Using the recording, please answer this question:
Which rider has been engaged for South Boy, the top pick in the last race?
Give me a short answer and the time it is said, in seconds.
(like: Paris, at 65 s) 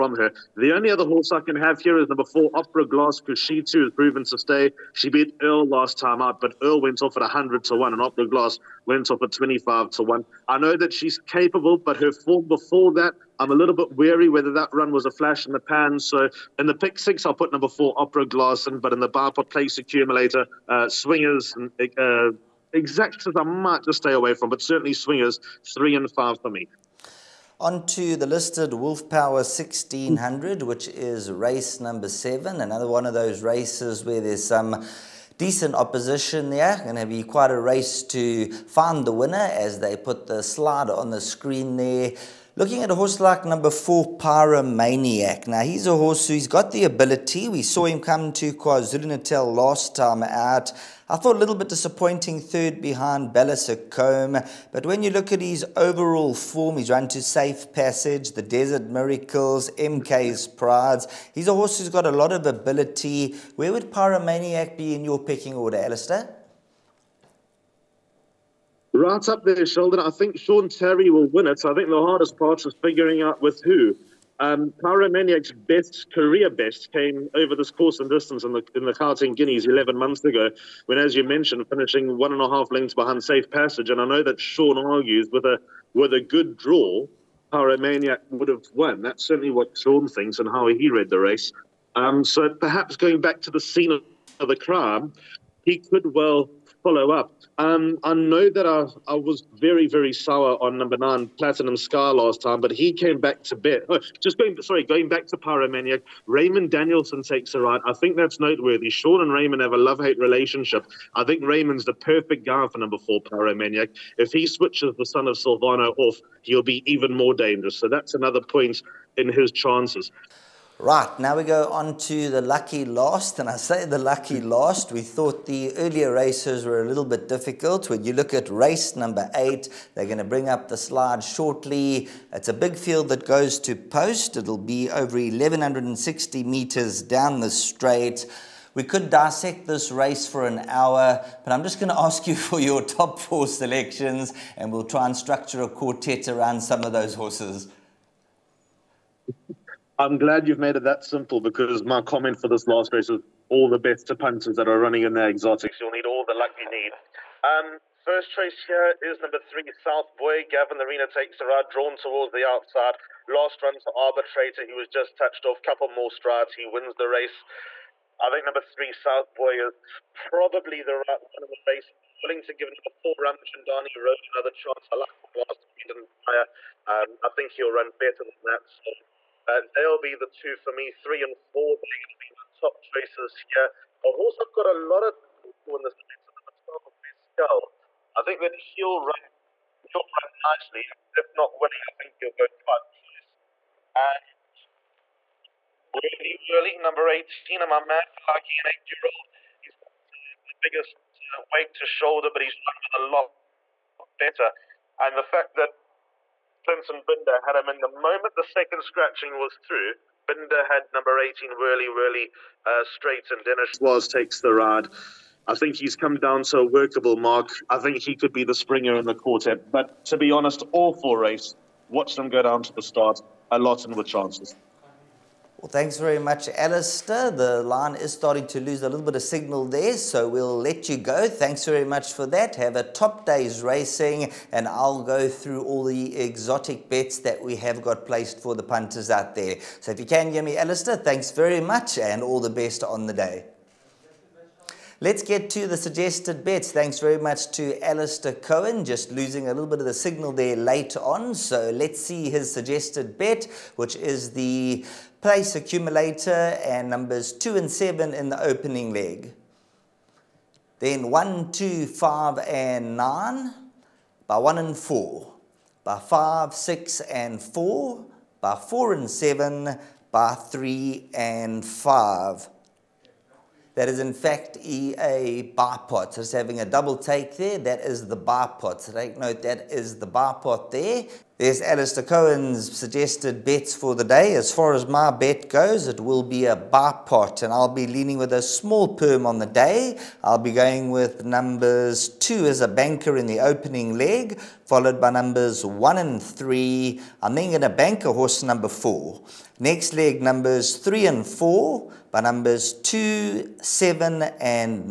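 Gavin Lerena, at 160 s.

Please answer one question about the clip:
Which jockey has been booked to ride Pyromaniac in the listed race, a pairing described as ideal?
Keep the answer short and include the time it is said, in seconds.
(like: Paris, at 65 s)
Raymond Danielson, at 106 s.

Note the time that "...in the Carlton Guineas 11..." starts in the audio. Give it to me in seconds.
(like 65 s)
78 s.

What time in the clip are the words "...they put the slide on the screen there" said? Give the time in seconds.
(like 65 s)
39 s.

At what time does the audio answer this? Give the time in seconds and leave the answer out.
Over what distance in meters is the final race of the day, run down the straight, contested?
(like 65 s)
135 s.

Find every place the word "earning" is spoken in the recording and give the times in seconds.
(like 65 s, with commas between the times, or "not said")
not said.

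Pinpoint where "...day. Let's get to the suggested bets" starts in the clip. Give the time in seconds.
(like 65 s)
243 s.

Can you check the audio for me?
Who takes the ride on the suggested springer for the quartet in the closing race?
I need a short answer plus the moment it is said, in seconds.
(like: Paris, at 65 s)
Dennis Schwarz, at 213 s.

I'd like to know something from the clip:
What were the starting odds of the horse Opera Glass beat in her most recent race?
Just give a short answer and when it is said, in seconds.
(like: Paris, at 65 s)
100 to 1, at 7 s.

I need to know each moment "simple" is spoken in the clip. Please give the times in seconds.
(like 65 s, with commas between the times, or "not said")
151 s.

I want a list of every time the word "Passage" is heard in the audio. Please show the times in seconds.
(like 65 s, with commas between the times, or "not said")
57 s, 83 s.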